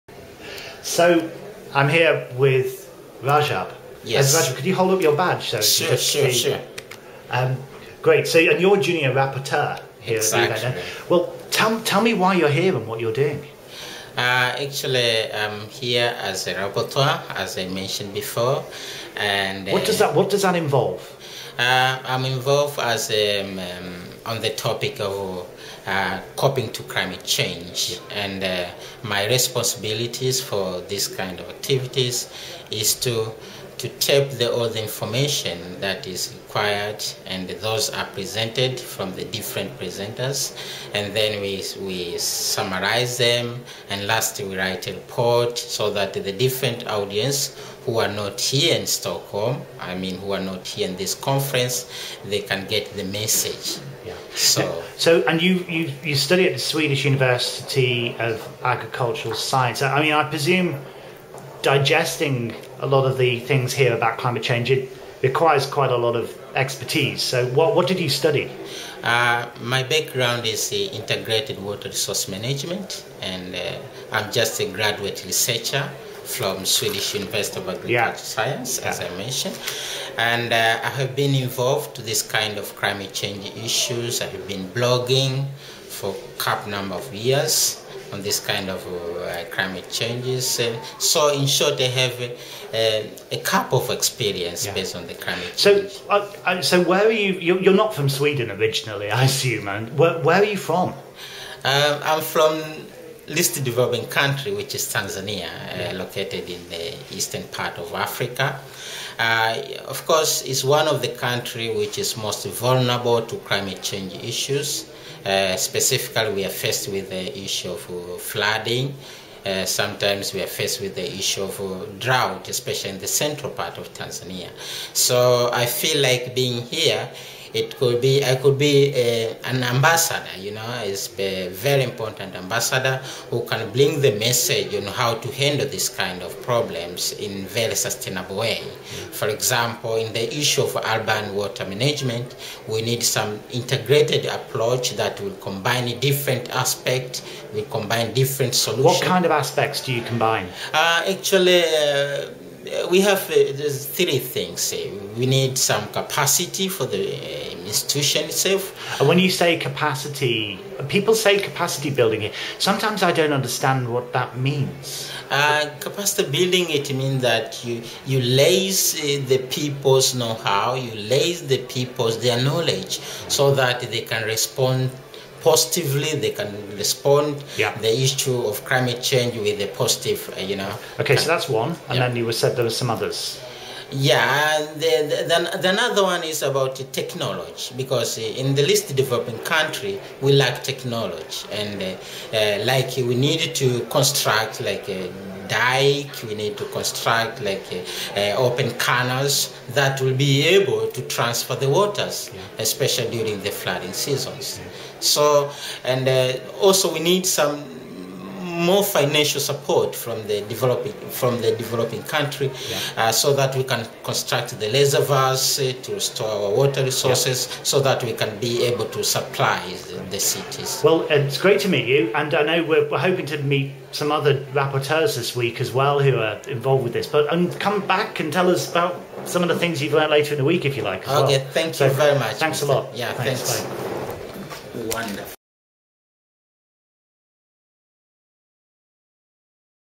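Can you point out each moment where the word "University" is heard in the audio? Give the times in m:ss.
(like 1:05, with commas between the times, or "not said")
0:57, 1:17.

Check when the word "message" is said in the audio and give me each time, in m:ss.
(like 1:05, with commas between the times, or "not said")
0:53, 2:14.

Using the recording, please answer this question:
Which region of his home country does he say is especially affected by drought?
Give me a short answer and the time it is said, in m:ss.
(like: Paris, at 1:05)
Central part, at 2:03.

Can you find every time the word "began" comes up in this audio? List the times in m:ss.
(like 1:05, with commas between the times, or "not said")
not said.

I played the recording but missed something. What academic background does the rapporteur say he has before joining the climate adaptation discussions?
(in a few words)
Integrated water resource management.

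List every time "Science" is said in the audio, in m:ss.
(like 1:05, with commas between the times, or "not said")
0:59, 1:18.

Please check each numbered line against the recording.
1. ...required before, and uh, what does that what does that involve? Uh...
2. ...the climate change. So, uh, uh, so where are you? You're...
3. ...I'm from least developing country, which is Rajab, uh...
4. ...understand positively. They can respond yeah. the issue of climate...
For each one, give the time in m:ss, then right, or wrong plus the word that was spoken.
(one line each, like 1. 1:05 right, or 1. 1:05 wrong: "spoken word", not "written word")
1. 0:17 wrong: "mentioned", not "required"
2. 1:35 right
3. 1:42 wrong: "Tanzania", not "Rajab"
4. 2:54 wrong: "respond", not "understand".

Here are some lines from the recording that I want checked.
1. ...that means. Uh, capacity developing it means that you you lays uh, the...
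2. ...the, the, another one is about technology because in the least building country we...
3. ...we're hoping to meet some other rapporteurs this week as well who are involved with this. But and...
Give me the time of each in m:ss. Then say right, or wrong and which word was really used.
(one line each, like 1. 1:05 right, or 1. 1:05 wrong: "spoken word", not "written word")
1. 2:44 wrong: "building", not "developing"
2. 3:05 wrong: "developing", not "building"
3. 3:42 right.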